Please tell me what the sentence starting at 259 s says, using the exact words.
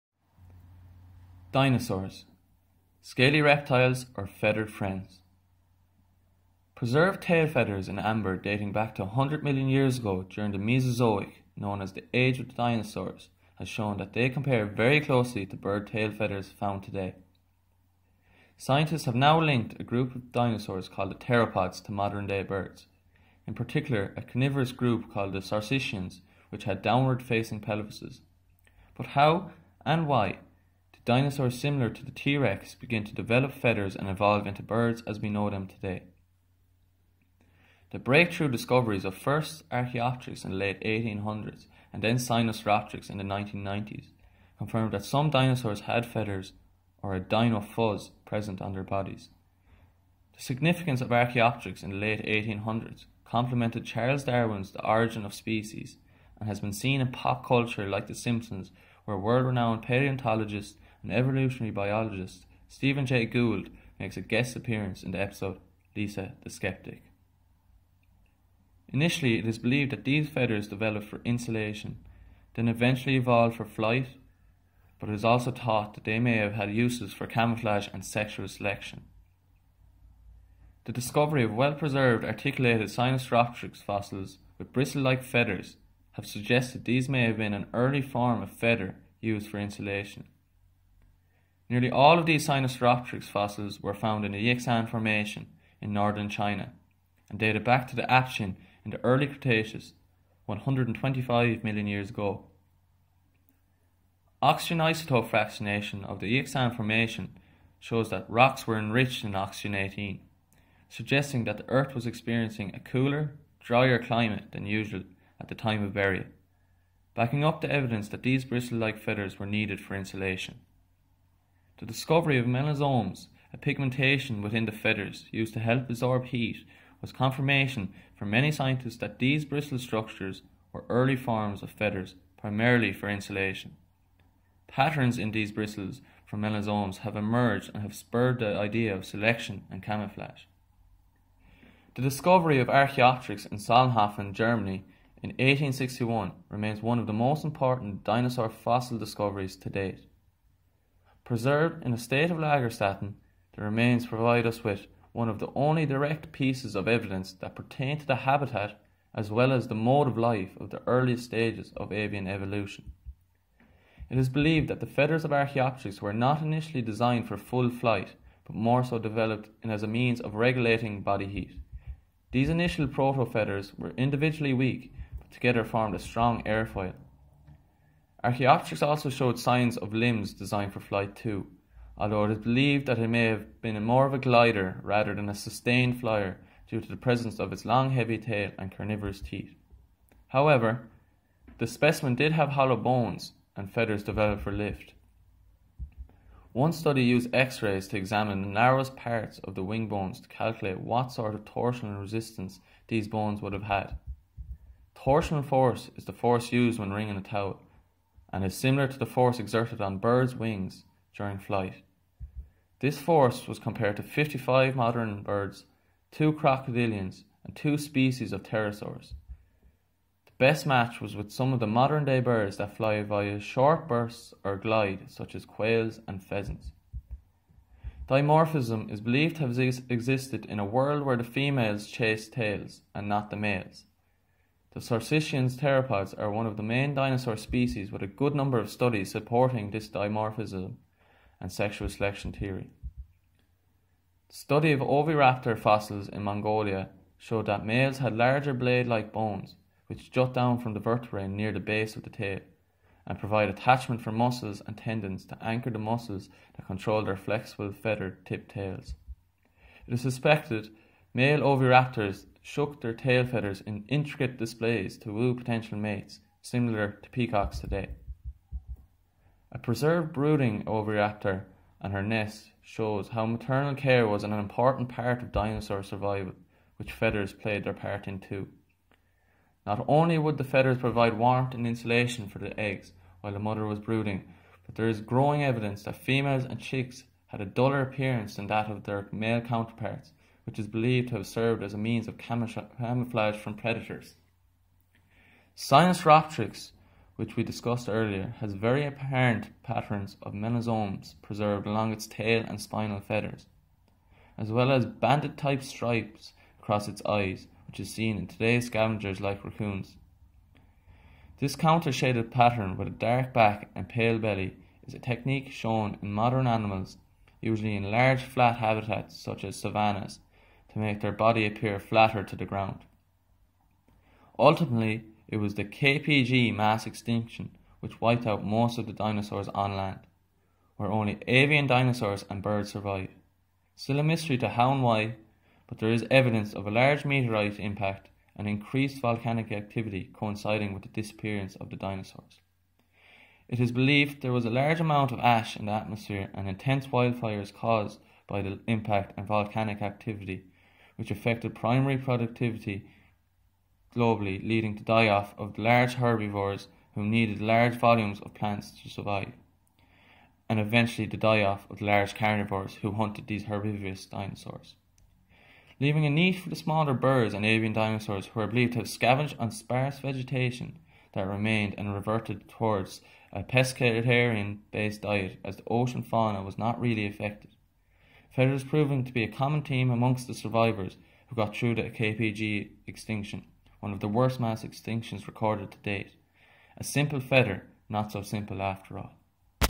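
It is suspected male oviraptors shook their tail feathers in intricate displays to woo potential mates, similar to peacocks today.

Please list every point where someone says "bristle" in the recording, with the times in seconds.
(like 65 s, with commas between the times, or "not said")
84 s, 118 s, 129 s, 135 s.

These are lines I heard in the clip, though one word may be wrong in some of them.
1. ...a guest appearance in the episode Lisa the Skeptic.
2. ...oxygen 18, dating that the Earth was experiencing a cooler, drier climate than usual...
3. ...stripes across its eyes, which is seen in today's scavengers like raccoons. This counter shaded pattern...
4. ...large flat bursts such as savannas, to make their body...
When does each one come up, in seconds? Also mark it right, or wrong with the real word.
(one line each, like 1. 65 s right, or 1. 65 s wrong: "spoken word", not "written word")
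1. 64 s right
2. 109 s wrong: "suggesting", not "dating"
3. 305 s right
4. 317 s wrong: "habitats", not "bursts".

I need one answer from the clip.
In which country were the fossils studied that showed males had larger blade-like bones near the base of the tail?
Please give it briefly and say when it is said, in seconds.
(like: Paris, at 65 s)
Mongolia, at 246 s.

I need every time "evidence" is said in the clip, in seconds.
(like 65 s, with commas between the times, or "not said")
117 s, 156 s, 285 s, 336 s.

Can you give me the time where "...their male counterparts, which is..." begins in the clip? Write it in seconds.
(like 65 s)
288 s.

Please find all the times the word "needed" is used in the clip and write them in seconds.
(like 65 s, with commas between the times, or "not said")
119 s, 357 s.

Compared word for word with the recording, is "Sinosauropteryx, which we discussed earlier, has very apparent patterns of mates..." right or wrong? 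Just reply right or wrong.
wrong.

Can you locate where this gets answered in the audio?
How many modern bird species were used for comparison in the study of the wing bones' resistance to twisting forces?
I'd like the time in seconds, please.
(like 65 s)
214 s.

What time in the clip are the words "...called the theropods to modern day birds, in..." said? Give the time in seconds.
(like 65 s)
20 s.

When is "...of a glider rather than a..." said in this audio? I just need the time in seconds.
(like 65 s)
184 s.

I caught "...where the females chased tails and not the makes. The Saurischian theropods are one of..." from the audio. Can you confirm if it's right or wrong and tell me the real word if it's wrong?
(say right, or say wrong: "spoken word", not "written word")
wrong: "males", not "makes".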